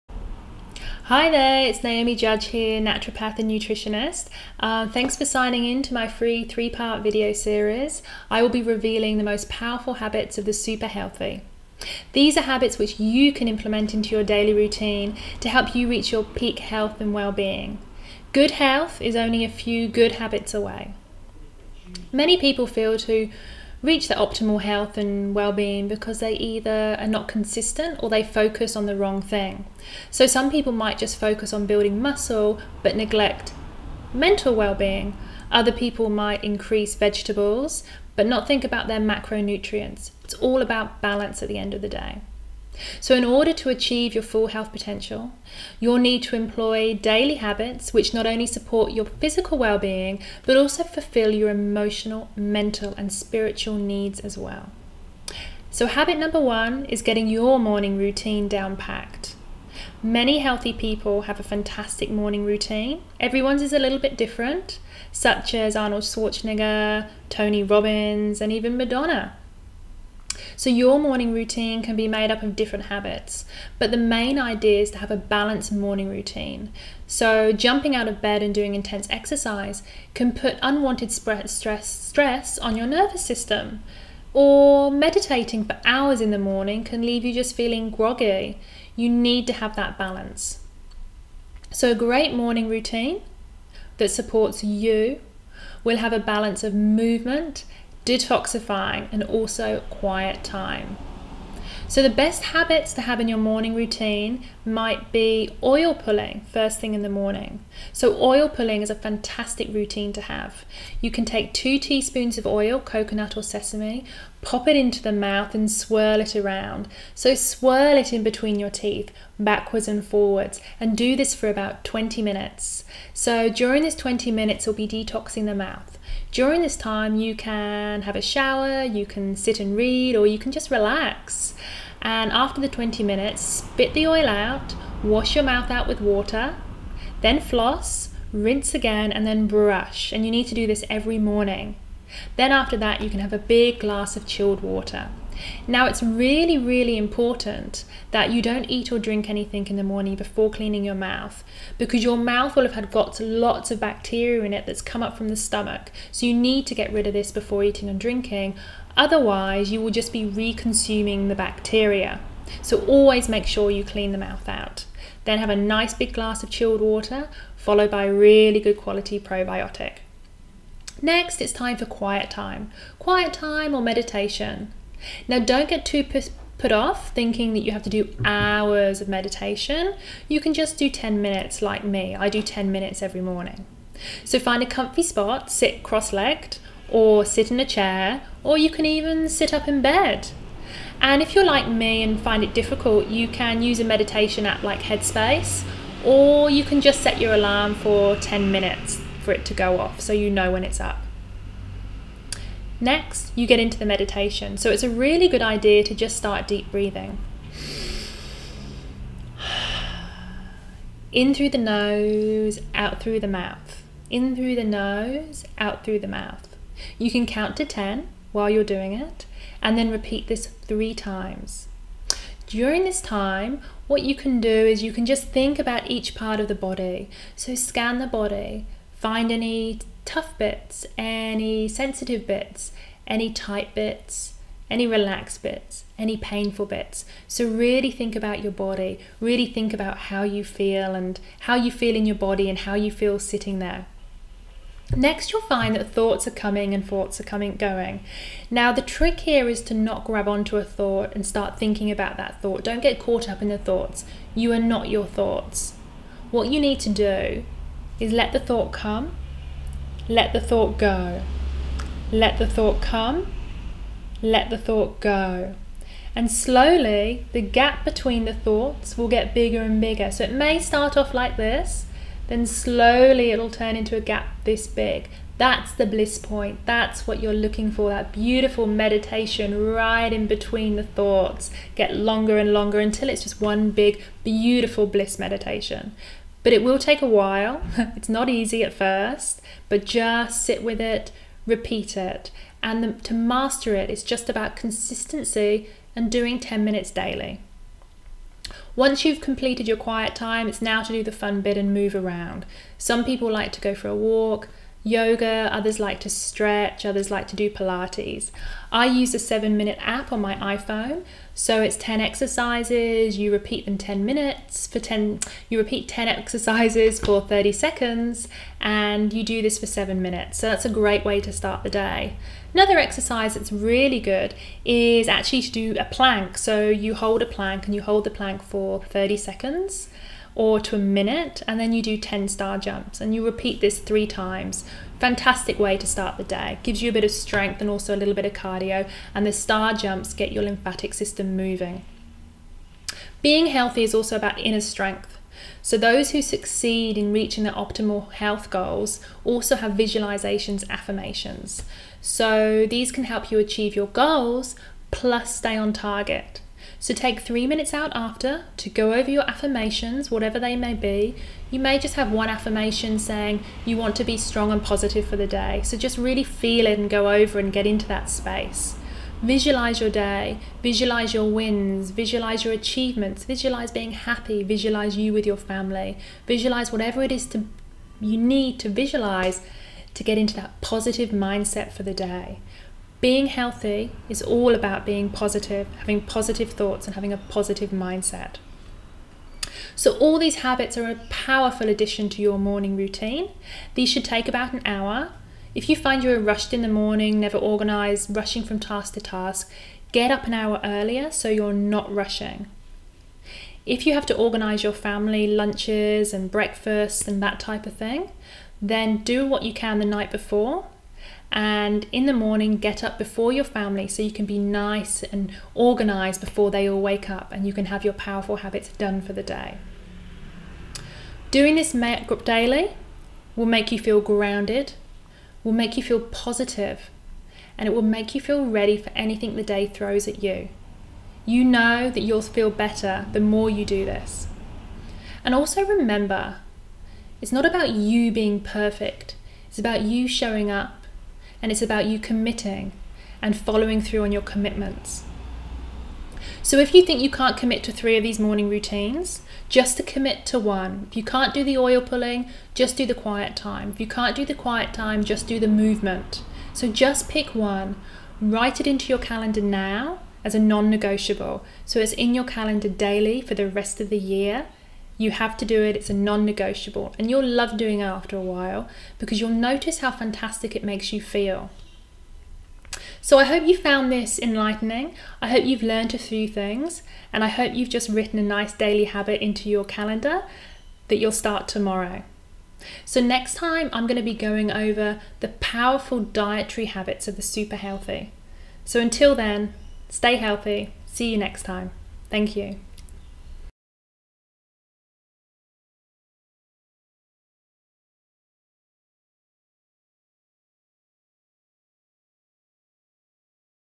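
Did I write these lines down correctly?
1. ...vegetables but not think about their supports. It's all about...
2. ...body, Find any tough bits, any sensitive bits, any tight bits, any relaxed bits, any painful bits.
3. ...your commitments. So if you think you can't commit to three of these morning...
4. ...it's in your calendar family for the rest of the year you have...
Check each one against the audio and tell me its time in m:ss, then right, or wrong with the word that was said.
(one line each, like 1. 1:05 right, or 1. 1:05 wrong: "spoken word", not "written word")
1. 0:36 wrong: "macronutrients", not "supports"
2. 3:48 right
3. 7:24 right
4. 7:41 wrong: "daily", not "family".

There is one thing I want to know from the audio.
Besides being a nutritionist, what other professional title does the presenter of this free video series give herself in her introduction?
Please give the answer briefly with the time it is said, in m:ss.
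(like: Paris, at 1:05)
Naturopath, at 0:02.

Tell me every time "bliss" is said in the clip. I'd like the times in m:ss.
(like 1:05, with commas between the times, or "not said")
4:35, 4:44.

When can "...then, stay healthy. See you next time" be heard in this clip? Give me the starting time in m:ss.
8:09.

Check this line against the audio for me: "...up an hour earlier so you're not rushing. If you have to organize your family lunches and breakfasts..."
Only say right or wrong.
right.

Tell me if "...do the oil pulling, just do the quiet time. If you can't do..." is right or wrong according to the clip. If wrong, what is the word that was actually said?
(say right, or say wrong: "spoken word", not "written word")
right.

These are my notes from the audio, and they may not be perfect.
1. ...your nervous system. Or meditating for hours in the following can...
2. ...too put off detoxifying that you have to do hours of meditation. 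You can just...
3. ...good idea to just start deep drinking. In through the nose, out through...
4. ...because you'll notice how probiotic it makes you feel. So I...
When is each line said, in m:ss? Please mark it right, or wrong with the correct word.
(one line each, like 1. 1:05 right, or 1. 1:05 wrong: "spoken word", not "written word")
1. 1:22 wrong: "morning", not "following"
2. 2:55 wrong: "thinking", not "detoxifying"
3. 3:25 wrong: "breathing", not "drinking"
4. 7:48 wrong: "fantastic", not "probiotic".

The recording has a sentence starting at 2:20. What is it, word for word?
And you need to do this every morning.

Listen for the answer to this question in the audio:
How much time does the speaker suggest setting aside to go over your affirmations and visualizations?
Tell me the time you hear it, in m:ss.
5:57.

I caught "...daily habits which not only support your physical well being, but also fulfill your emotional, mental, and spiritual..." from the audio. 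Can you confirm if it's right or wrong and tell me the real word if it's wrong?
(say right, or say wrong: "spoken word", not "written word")
right.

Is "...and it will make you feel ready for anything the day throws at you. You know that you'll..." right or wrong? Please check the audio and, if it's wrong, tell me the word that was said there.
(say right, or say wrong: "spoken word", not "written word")
right.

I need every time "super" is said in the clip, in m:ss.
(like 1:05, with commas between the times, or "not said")
0:10, 8:07.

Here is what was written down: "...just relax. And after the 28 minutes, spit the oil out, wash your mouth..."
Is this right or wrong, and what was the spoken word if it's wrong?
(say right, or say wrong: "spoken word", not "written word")
wrong: "20", not "28".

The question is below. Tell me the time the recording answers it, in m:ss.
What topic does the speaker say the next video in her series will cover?
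8:06.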